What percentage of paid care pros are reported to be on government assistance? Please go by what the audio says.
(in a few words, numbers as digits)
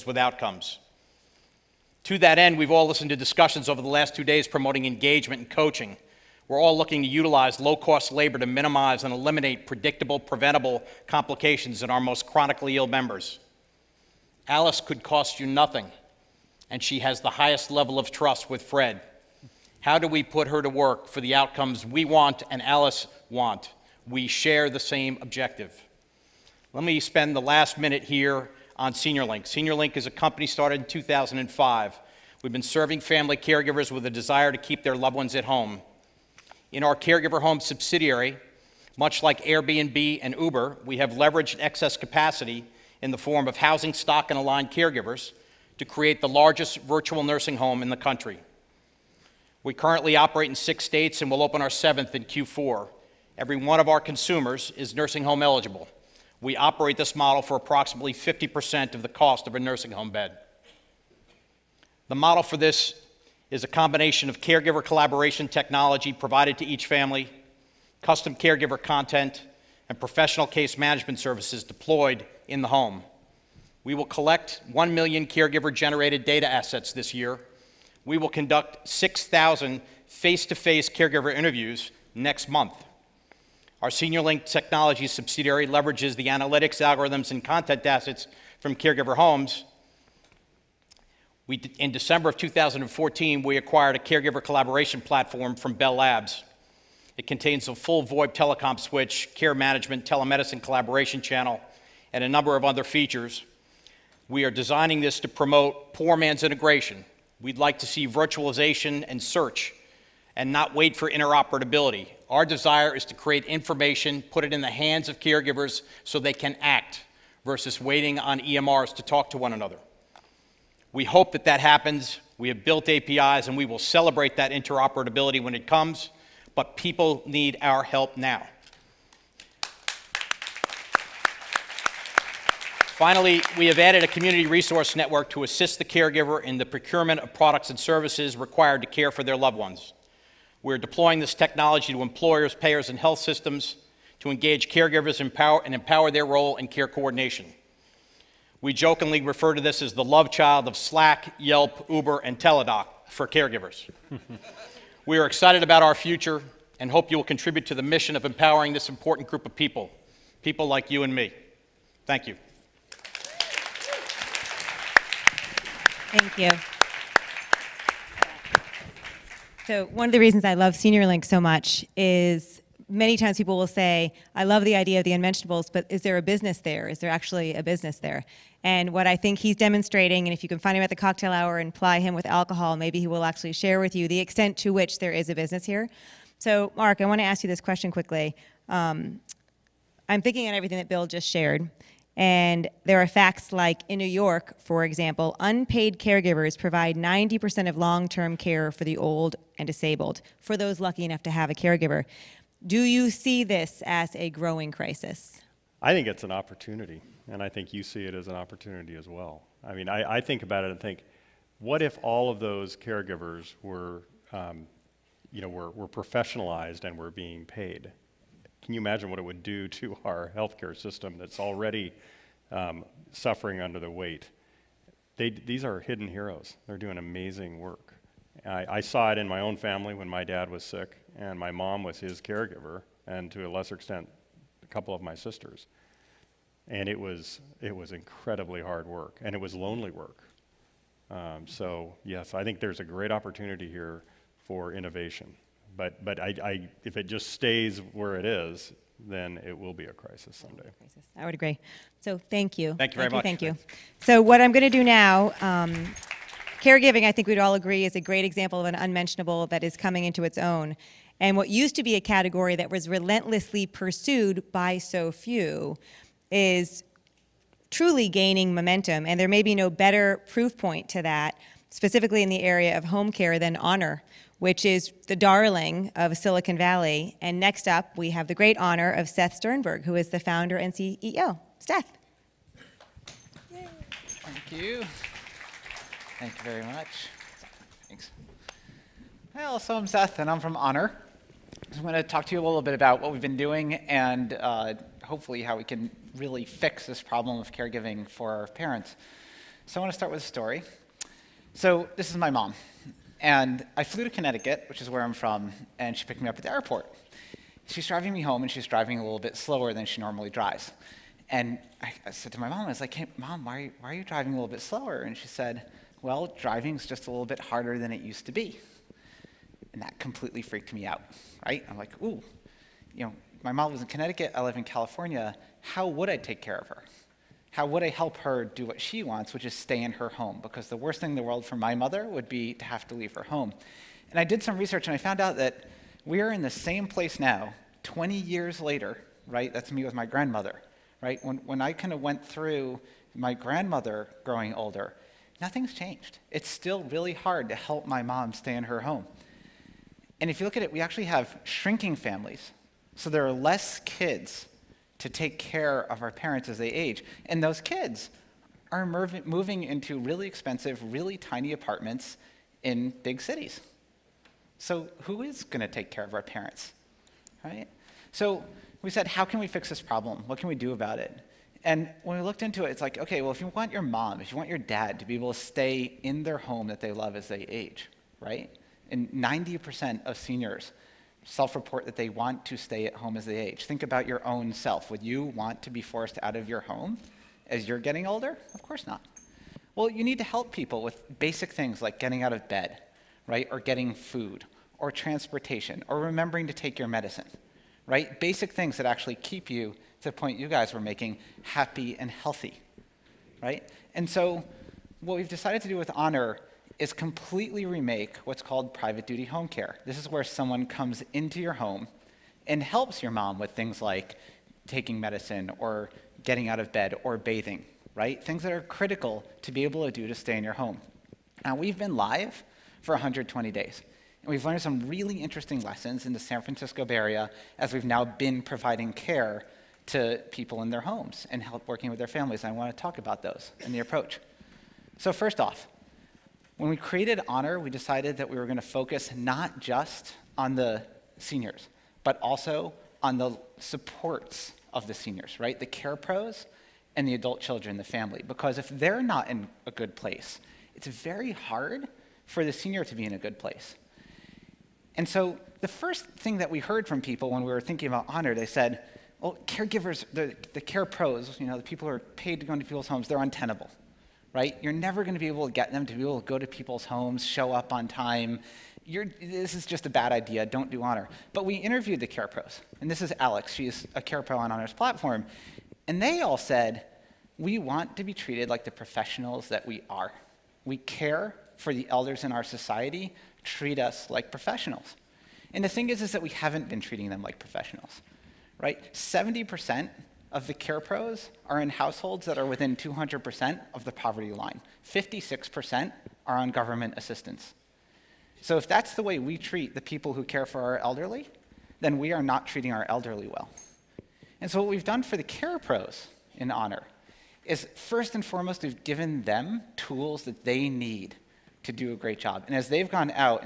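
56%.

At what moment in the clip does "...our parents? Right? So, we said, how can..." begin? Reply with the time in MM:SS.
06:06.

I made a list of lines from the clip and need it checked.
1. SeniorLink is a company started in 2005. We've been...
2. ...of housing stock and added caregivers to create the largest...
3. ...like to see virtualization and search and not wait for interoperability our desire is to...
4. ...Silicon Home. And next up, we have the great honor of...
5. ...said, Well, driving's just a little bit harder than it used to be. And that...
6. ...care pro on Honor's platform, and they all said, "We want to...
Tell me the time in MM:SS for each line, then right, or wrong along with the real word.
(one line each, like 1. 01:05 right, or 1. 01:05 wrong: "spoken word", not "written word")
1. 00:29 right
2. 00:43 wrong: "aligned", not "added"
3. 01:47 right
4. 04:36 wrong: "Valley", not "Home"
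5. 05:15 right
6. 07:54 right.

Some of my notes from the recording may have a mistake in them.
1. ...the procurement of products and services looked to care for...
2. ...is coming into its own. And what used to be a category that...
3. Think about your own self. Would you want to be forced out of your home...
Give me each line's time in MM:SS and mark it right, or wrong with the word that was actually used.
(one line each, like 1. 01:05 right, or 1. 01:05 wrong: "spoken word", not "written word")
1. 02:16 wrong: "required", not "looked"
2. 04:19 right
3. 06:23 right.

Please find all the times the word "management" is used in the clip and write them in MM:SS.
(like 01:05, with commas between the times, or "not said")
01:10, 01:39.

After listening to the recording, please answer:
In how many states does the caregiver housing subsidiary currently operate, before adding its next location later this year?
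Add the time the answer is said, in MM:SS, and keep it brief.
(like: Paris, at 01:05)
6, at 00:50.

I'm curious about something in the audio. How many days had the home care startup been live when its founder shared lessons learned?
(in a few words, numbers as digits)
120.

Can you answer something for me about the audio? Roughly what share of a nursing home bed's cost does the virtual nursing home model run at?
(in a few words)
50%.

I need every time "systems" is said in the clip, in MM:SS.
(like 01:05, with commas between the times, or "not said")
02:23, 03:40.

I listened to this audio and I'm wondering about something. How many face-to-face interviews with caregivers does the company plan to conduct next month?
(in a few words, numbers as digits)
6,000.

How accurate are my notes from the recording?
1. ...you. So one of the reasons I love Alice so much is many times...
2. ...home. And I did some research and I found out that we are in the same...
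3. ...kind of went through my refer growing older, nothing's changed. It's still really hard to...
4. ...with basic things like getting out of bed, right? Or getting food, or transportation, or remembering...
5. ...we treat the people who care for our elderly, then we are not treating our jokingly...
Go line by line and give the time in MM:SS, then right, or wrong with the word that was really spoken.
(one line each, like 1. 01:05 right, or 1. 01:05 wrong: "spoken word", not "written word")
1. 02:46 wrong: "SeniorLink", not "Alice"
2. 05:33 right
3. 05:41 wrong: "grandmother", not "refer"
4. 06:30 right
5. 08:19 wrong: "elderly", not "jokingly".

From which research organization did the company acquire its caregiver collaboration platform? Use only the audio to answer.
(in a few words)
Bell Labs.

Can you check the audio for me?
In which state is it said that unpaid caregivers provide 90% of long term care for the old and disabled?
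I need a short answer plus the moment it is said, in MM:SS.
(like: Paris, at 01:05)
New York, at 03:13.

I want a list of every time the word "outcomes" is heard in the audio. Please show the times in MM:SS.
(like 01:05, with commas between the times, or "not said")
00:00, 00:21.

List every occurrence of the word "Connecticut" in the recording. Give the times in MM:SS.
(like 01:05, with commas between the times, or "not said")
05:04, 05:23.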